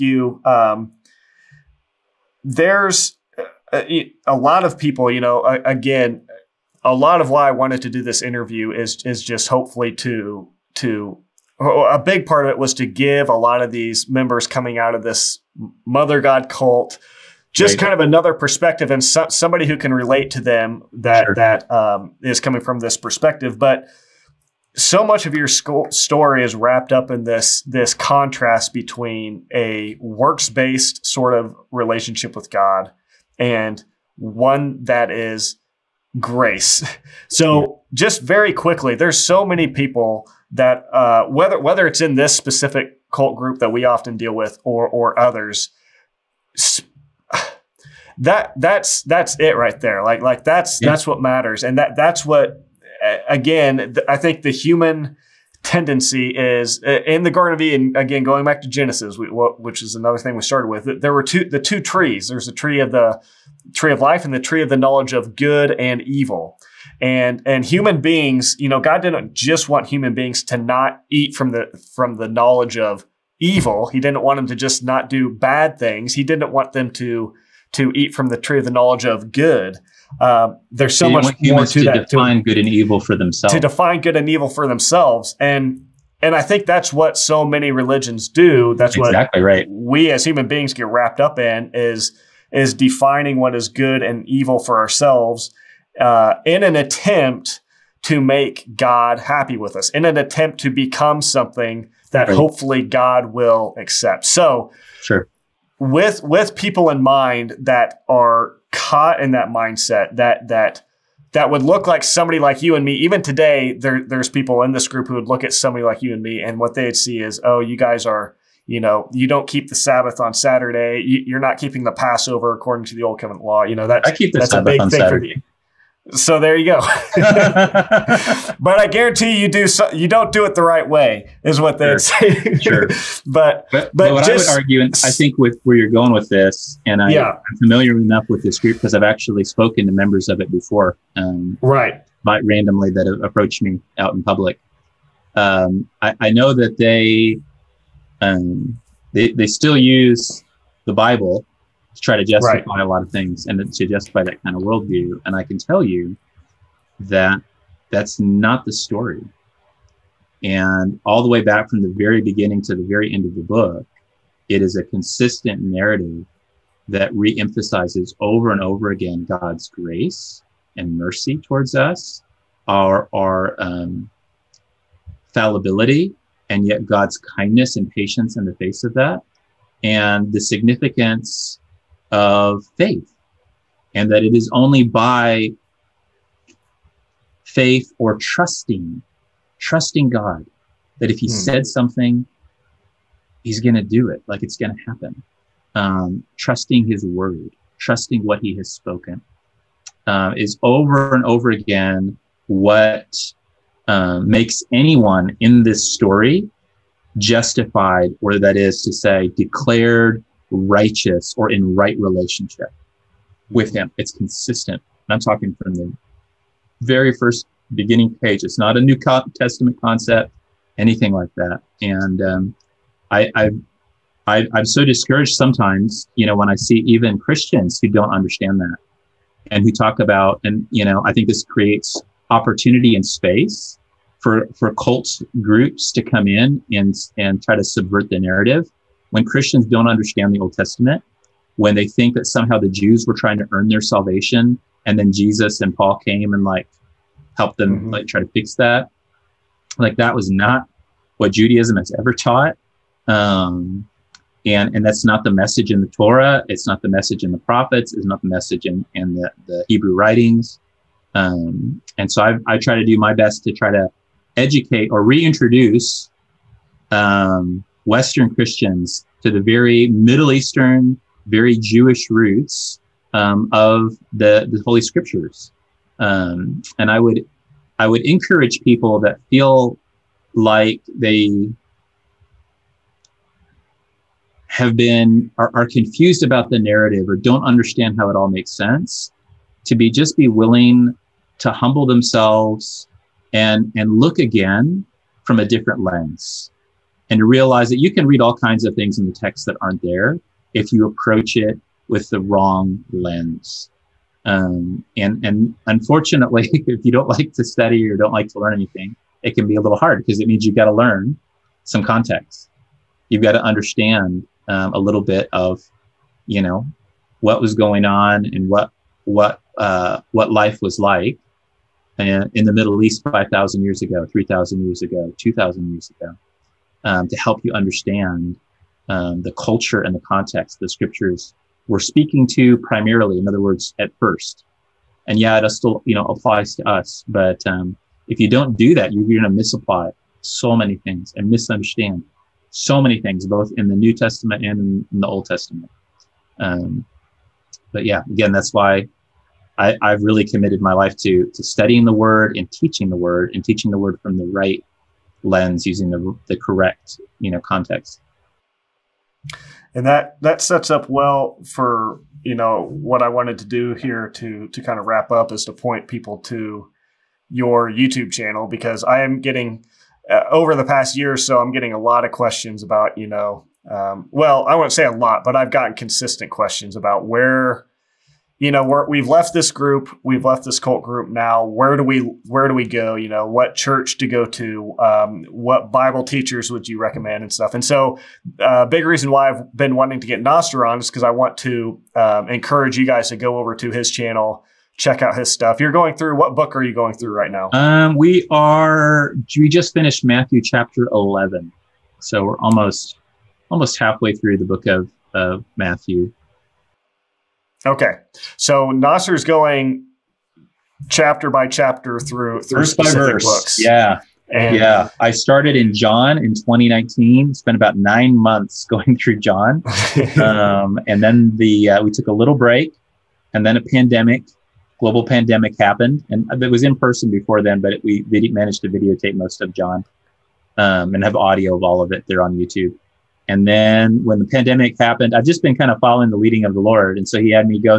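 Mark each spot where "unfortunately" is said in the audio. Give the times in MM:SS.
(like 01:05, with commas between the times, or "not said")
05:05.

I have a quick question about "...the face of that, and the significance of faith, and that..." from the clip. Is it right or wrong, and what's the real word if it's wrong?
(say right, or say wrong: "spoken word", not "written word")
right.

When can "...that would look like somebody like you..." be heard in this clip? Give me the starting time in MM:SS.
01:51.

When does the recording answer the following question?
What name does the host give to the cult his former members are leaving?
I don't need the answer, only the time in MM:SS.
00:15.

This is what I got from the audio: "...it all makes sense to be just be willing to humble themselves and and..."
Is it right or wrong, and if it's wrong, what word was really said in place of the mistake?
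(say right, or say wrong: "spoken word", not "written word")
right.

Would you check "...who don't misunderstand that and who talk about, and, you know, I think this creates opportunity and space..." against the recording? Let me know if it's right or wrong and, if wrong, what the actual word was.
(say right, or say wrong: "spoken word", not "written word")
wrong: "understand", not "misunderstand".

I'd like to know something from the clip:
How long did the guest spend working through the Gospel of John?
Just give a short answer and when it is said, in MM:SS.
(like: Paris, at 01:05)
Nine months, at 06:57.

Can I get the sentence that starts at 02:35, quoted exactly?
And I can tell you that that's not the story.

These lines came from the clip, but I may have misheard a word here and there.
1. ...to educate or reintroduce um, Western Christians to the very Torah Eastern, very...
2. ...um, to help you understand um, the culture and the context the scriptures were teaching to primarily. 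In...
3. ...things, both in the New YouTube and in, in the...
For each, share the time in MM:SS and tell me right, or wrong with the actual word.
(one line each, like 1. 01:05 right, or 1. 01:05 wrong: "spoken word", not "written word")
1. 04:23 wrong: "Middle", not "Torah"
2. 05:26 wrong: "speaking", not "teaching"
3. 05:43 wrong: "Testament", not "YouTube".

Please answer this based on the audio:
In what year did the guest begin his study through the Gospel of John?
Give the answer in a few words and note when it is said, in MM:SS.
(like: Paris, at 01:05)
2019, at 06:56.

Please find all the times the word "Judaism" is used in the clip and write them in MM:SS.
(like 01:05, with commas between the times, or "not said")
04:11.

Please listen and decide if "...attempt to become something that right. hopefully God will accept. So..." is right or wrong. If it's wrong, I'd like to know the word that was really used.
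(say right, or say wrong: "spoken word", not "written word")
right.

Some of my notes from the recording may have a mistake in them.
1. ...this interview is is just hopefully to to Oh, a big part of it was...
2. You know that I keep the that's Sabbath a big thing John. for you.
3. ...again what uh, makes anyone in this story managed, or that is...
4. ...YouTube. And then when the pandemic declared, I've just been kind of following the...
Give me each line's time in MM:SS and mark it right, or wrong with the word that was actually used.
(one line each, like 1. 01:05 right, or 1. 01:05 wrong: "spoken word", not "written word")
1. 00:08 right
2. 02:03 wrong: "Saturday", not "John"
3. 03:21 wrong: "justified", not "managed"
4. 07:12 wrong: "happened", not "declared".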